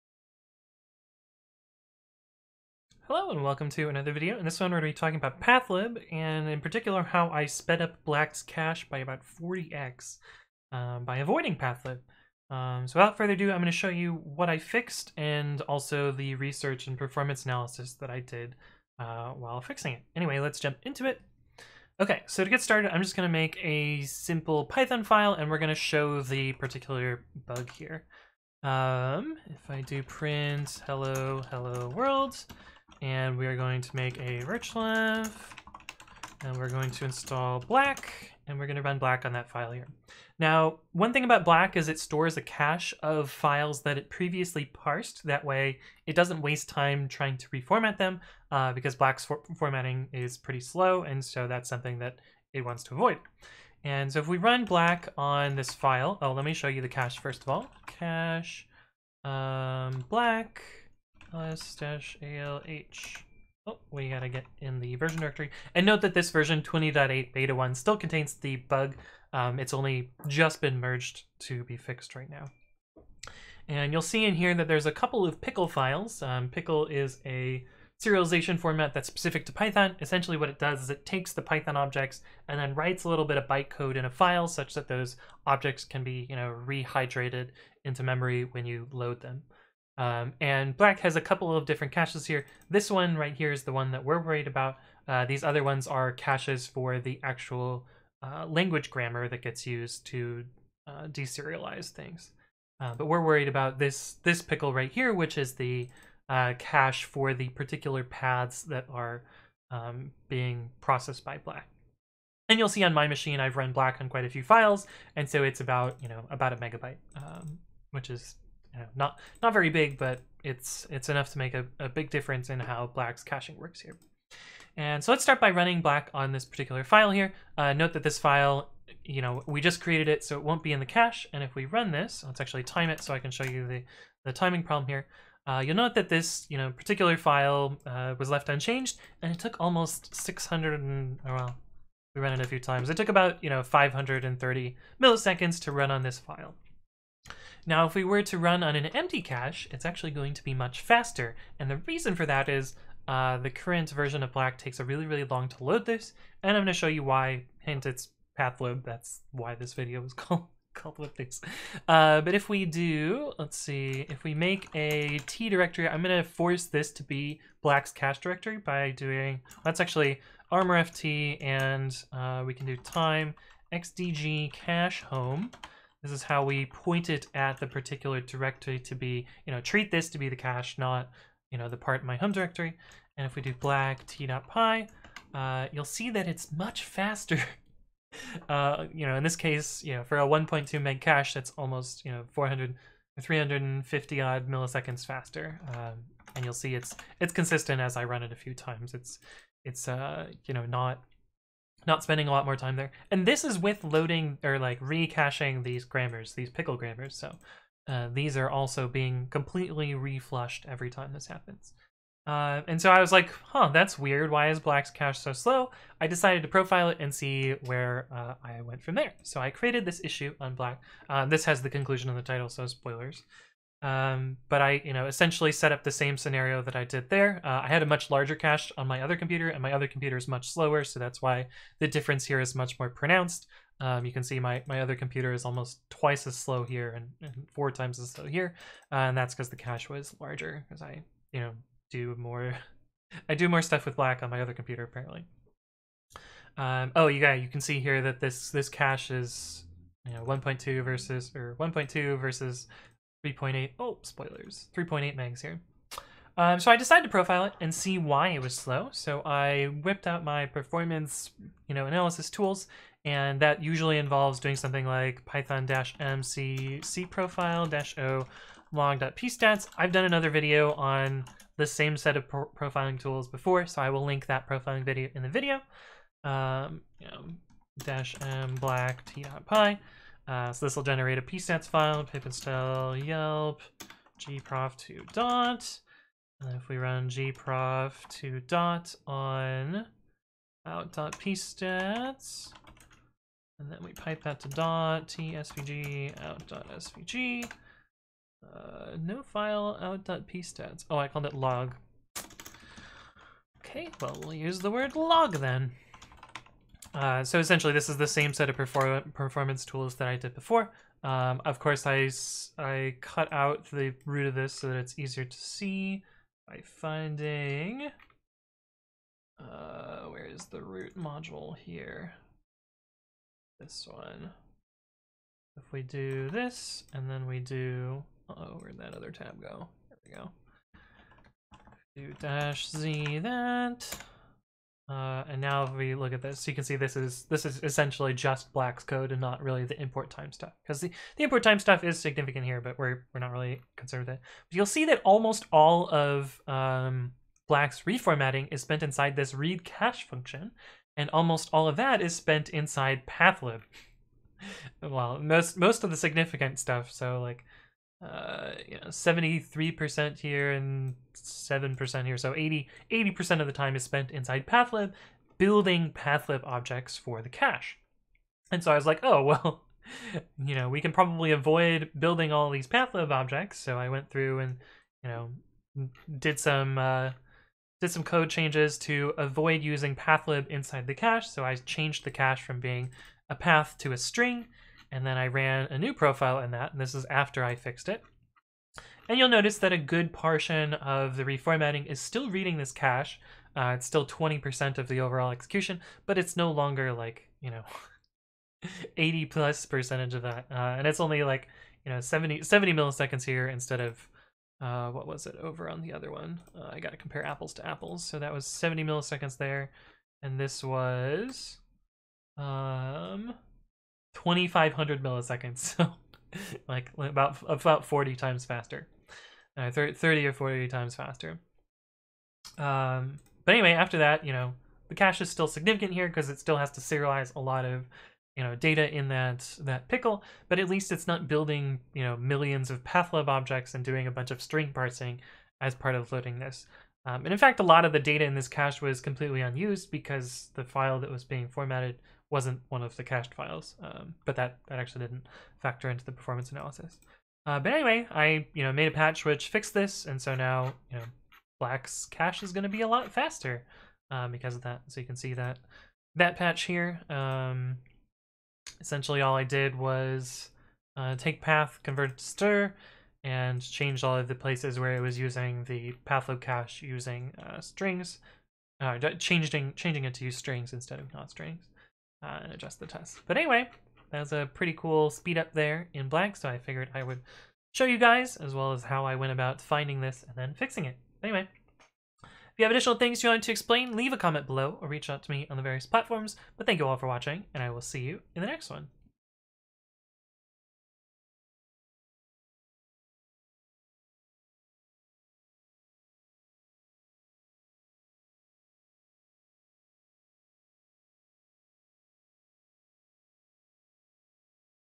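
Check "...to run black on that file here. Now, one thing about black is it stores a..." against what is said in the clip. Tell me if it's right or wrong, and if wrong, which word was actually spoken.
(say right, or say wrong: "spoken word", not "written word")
right.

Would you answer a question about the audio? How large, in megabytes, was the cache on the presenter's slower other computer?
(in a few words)
3.8 megs.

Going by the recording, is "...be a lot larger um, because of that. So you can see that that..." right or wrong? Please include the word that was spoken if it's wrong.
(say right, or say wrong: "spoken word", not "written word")
wrong: "faster", not "larger".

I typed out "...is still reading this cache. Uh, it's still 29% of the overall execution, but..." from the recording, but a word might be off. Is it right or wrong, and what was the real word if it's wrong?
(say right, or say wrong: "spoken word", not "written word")
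wrong: "20", not "29".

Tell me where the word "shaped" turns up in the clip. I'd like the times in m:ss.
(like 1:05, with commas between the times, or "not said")
not said.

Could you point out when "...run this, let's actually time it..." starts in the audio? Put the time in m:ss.
2:11.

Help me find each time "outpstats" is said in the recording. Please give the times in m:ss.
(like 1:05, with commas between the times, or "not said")
4:50, 4:59.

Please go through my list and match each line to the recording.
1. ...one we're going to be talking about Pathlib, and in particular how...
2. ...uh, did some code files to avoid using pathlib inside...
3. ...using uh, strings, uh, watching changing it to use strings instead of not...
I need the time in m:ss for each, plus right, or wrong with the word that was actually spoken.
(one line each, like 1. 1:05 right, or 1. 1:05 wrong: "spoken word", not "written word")
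1. 0:04 right
2. 6:16 wrong: "changes", not "files"
3. 7:46 wrong: "changing", not "watching".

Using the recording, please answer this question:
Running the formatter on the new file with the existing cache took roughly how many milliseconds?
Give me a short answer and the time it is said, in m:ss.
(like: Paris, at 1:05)
530, at 2:23.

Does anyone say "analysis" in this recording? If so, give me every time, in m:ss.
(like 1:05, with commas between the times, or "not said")
0:17, 4:21, 7:26.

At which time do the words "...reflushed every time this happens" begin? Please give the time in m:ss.
3:29.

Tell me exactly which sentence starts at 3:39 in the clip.
So I created this issue on Black.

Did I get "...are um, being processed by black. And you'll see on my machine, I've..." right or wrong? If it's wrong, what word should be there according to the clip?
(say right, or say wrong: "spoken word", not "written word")
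right.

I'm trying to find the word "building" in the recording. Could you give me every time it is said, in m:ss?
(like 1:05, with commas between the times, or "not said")
6:05, 6:11, 7:11.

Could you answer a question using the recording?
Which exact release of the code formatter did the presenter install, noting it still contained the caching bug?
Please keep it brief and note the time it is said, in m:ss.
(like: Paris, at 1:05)
20.8 beta 1, at 1:06.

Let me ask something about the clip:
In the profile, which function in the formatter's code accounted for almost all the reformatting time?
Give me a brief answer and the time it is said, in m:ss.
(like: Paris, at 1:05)
read cache, at 5:49.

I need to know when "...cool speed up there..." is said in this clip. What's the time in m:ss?
7:54.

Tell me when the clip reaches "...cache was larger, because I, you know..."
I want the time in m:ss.
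3:59.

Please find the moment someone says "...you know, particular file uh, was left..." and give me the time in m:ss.
2:16.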